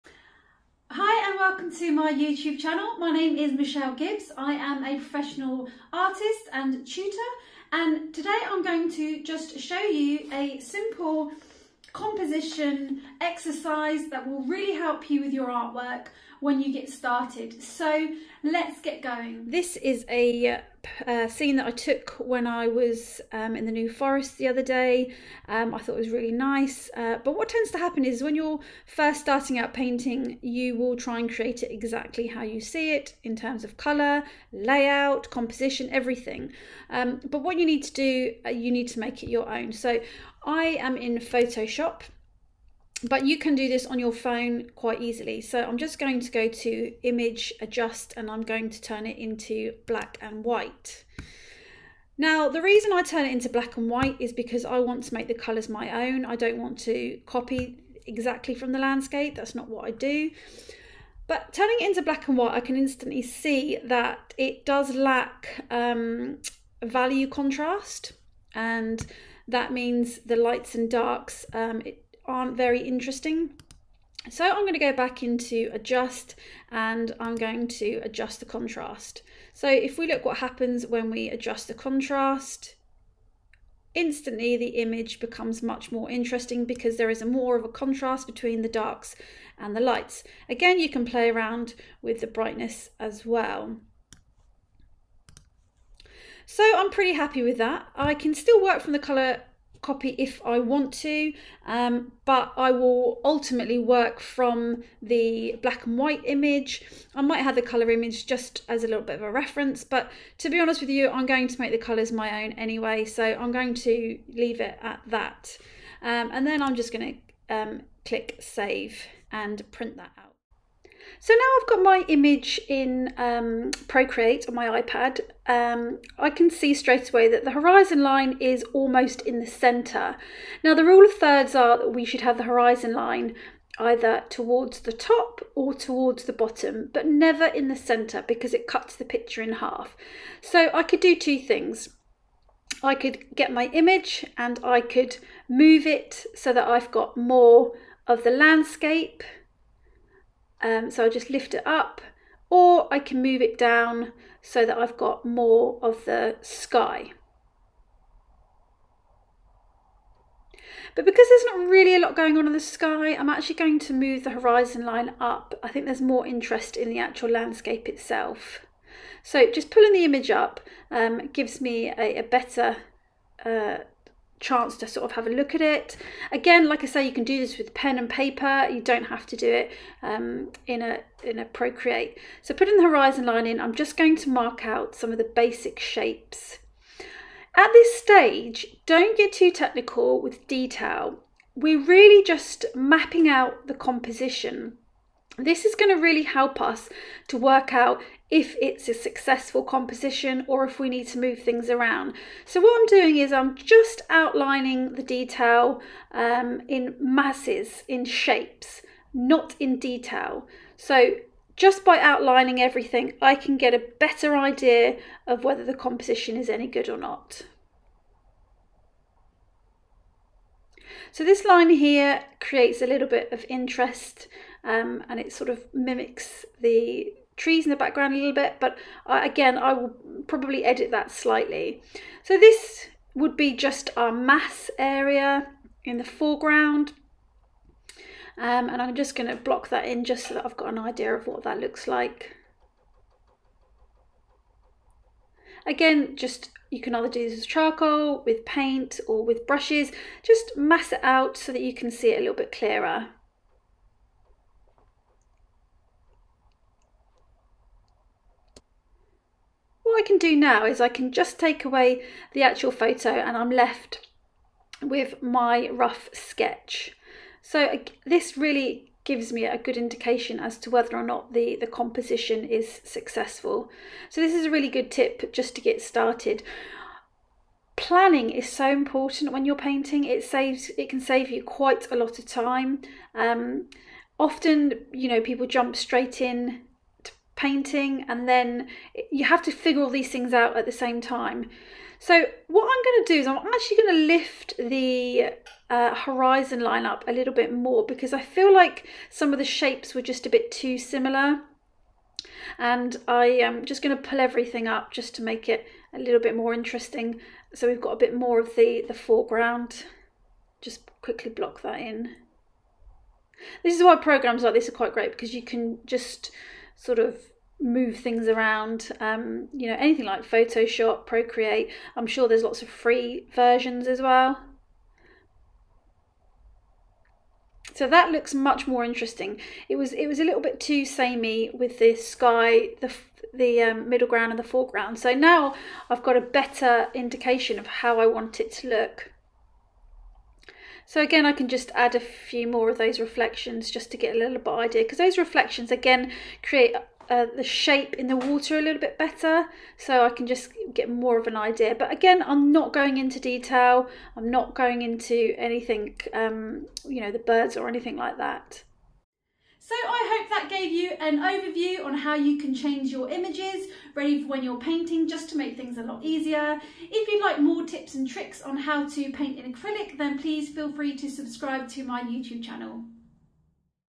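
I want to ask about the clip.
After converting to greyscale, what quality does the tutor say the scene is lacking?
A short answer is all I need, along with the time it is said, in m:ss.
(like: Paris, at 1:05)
Value contrast, at 1:06.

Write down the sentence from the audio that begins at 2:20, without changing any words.
So I could do two things.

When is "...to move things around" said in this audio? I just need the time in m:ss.
3:21.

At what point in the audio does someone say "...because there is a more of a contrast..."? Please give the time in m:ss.
1:26.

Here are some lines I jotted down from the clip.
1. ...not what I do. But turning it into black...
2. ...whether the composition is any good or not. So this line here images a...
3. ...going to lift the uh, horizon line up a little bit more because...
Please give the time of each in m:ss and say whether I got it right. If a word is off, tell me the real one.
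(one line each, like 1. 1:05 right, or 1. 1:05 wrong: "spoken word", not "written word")
1. 0:59 right
2. 3:35 wrong: "creates", not "images"
3. 4:53 right.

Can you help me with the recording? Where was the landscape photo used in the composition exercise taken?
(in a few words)
New Forest.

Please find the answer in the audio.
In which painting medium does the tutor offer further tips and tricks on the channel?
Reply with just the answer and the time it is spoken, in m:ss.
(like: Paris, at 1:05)
Acrylic, at 6:09.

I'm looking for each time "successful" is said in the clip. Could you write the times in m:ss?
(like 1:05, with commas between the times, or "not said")
3:18, 4:32.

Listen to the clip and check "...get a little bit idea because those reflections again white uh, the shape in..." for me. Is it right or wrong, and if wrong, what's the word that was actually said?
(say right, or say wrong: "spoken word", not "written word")
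wrong: "create", not "white".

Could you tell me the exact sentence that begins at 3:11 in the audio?
We're really just mapping out the composition.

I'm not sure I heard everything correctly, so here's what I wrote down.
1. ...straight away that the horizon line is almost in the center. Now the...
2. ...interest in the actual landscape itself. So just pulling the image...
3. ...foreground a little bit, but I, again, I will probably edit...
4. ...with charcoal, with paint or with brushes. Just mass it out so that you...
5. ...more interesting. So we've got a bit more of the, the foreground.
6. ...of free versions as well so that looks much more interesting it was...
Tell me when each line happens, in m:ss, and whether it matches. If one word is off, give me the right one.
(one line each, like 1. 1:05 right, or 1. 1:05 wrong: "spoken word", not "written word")
1. 2:06 right
2. 2:46 right
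3. 3:47 wrong: "background", not "foreground"
4. 4:07 right
5. 5:06 right
6. 5:22 right.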